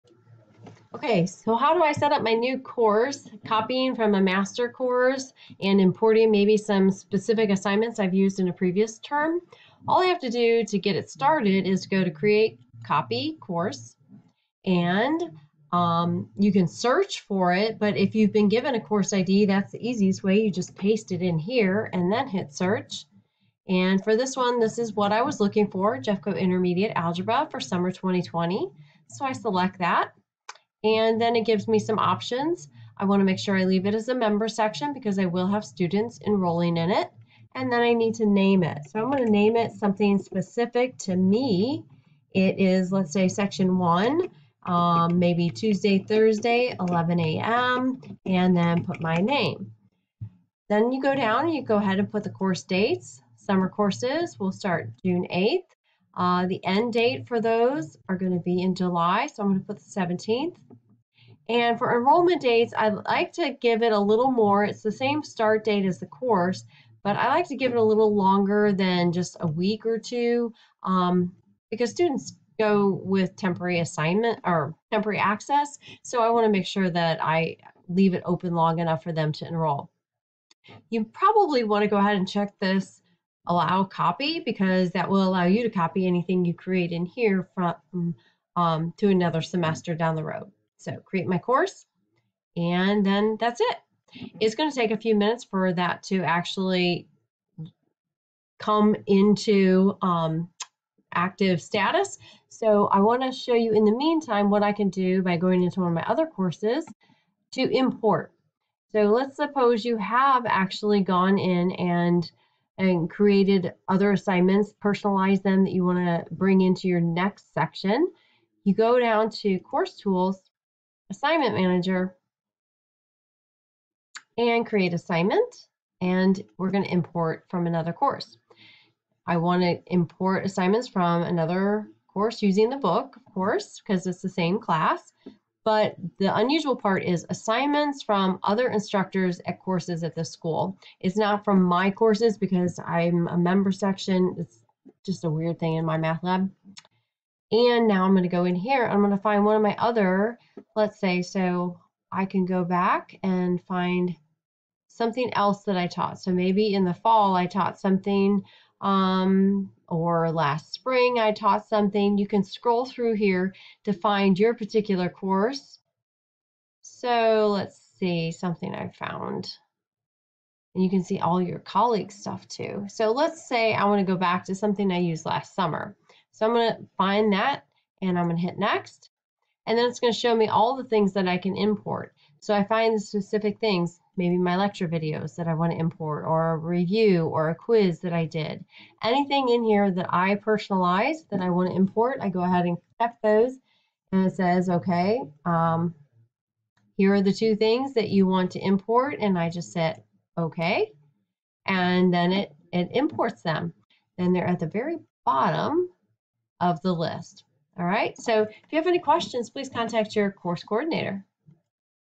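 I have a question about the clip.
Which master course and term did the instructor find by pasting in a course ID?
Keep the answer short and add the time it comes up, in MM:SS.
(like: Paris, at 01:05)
Jeffco Intermediate Algebra for summer 2020, at 00:26.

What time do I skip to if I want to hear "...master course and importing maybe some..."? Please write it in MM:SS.
00:04.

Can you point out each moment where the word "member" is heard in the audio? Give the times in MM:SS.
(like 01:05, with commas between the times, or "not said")
00:34, 02:23.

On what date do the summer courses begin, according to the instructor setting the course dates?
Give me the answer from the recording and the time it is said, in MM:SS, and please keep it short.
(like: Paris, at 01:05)
June 8th, at 00:55.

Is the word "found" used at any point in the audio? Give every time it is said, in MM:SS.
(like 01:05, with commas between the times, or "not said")
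02:48.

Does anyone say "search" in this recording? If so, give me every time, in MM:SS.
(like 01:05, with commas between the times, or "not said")
00:16, 00:22.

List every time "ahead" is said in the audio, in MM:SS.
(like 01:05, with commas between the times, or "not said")
00:51, 01:21, 03:12.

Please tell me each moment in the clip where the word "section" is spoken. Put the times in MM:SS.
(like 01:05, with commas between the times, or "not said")
00:34, 00:43, 01:57, 02:23.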